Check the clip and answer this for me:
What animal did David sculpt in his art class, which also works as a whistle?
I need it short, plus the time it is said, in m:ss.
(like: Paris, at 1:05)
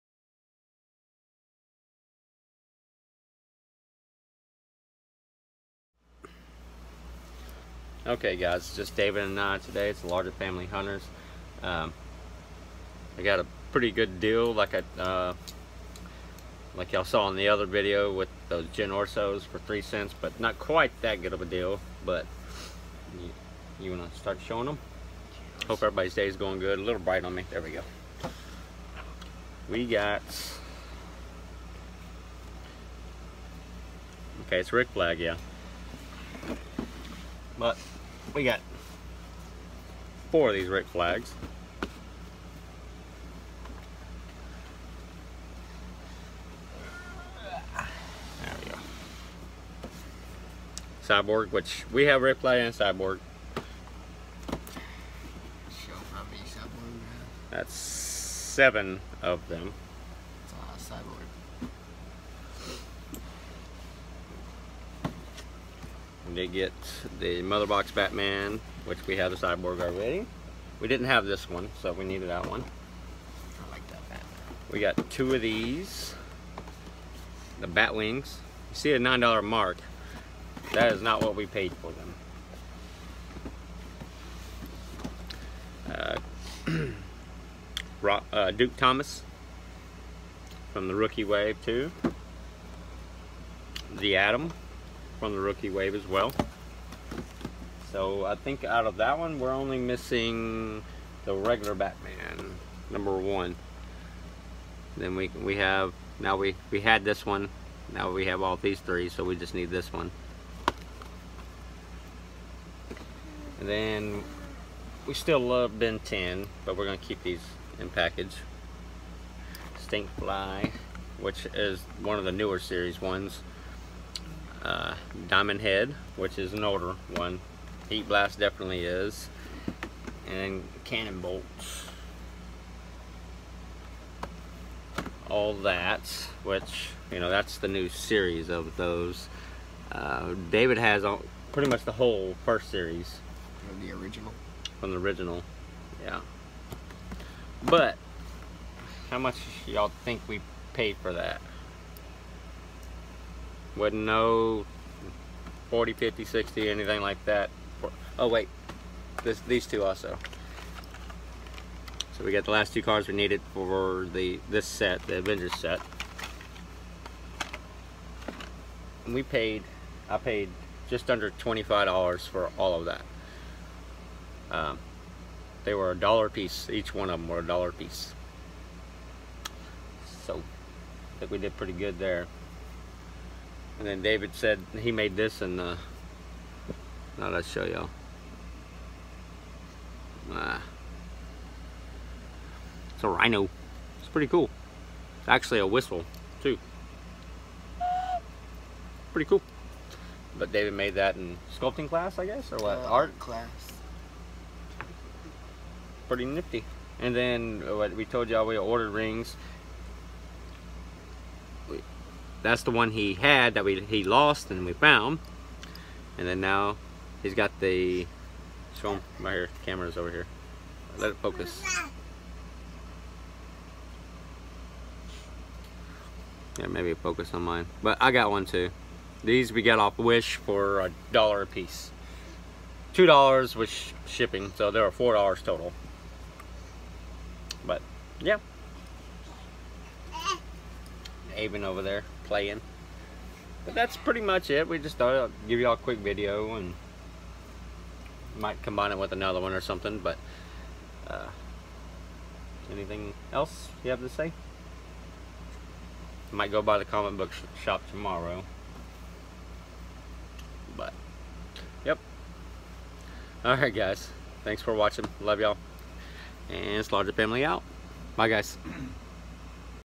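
rhino, at 3:13.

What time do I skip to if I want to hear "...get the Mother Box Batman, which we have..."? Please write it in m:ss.
1:06.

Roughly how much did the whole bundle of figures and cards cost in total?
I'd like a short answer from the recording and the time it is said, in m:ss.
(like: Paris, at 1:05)
just under $25, at 2:50.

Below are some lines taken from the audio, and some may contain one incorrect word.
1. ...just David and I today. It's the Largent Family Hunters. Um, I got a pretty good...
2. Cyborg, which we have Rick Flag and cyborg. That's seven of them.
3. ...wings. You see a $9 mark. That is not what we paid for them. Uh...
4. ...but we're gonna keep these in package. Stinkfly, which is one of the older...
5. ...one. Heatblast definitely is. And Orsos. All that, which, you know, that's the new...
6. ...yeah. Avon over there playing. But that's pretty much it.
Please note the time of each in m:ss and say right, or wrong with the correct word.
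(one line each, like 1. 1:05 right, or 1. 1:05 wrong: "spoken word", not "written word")
1. 0:08 right
2. 0:51 right
3. 1:17 right
4. 1:56 wrong: "newer", not "older"
5. 2:07 wrong: "Cannonbolts", not "Orsos"
6. 3:58 right.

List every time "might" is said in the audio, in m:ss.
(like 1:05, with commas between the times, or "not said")
4:08, 4:16.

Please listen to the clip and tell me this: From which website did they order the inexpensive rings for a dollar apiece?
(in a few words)
Wish.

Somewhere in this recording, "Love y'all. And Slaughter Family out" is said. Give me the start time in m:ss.
4:25.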